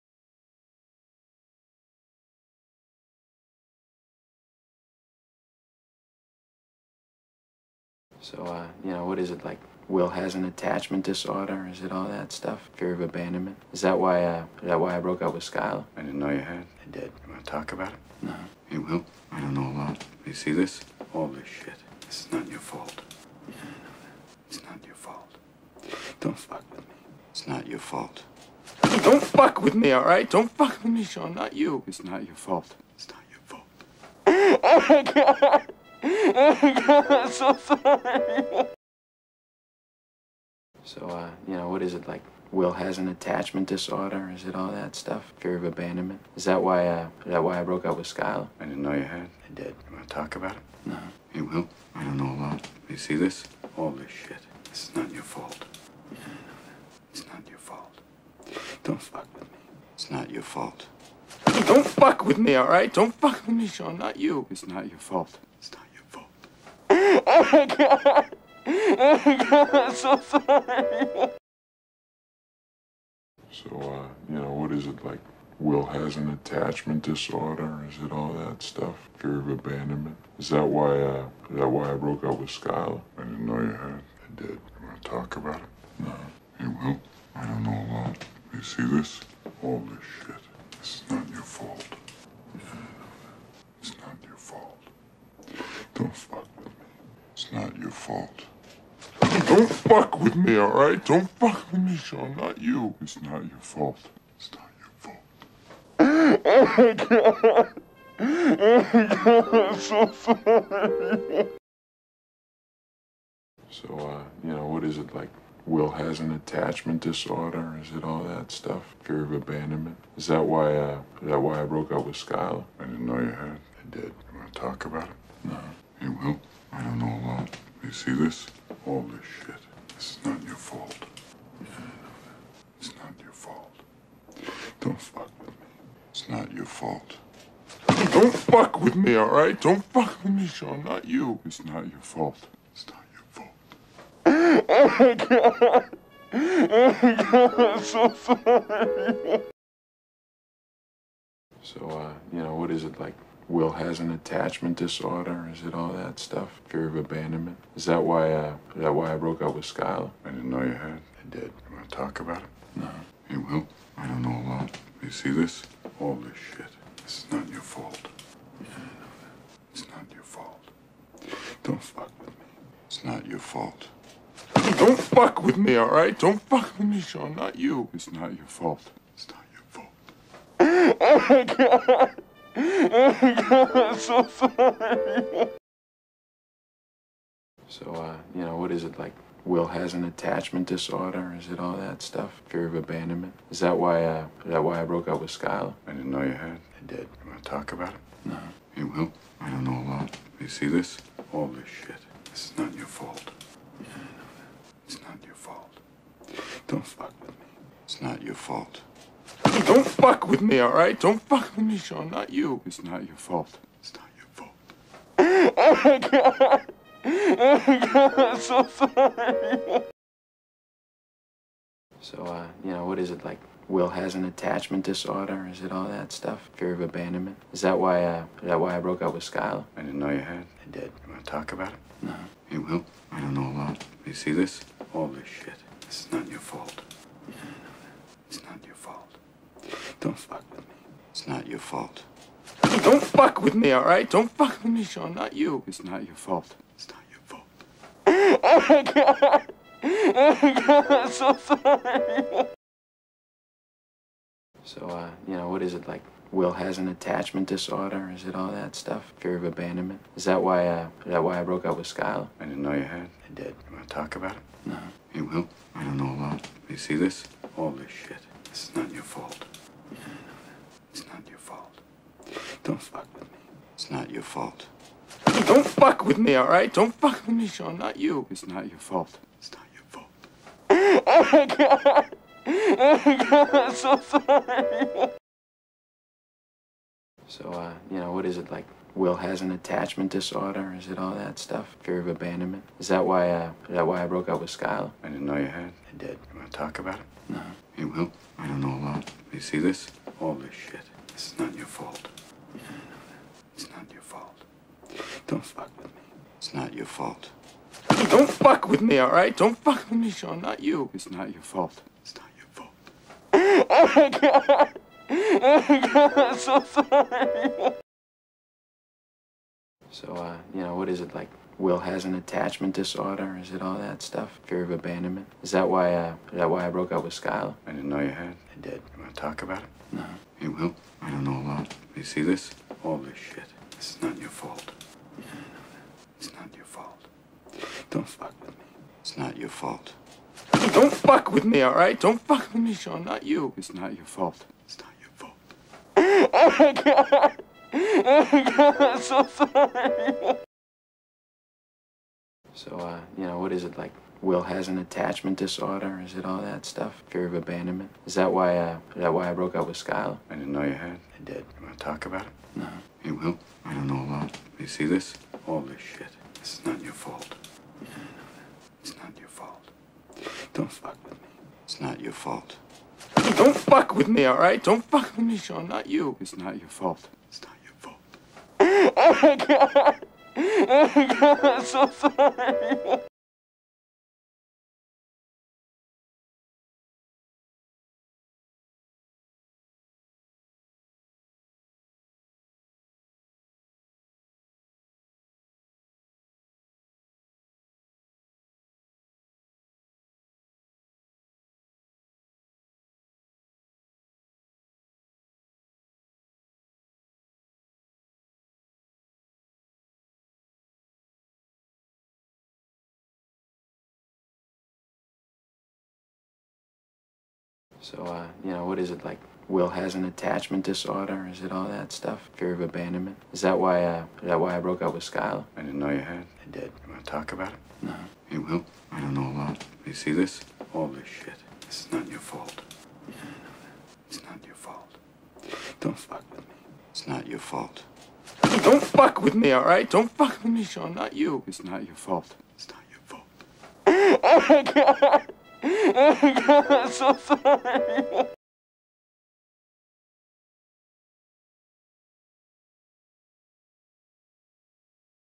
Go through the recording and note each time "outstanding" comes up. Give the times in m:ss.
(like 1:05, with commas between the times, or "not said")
not said.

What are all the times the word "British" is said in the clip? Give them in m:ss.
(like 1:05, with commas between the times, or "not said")
not said.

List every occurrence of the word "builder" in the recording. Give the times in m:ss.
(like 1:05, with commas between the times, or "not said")
not said.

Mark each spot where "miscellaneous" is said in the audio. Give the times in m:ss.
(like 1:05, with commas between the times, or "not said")
not said.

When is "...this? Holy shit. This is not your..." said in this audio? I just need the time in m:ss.
2:08.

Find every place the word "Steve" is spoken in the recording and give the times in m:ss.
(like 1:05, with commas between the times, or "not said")
not said.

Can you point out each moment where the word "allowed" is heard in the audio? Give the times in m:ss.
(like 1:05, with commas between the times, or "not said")
not said.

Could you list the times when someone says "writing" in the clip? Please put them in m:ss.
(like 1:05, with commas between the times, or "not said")
not said.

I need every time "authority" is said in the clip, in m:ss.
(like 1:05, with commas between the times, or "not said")
not said.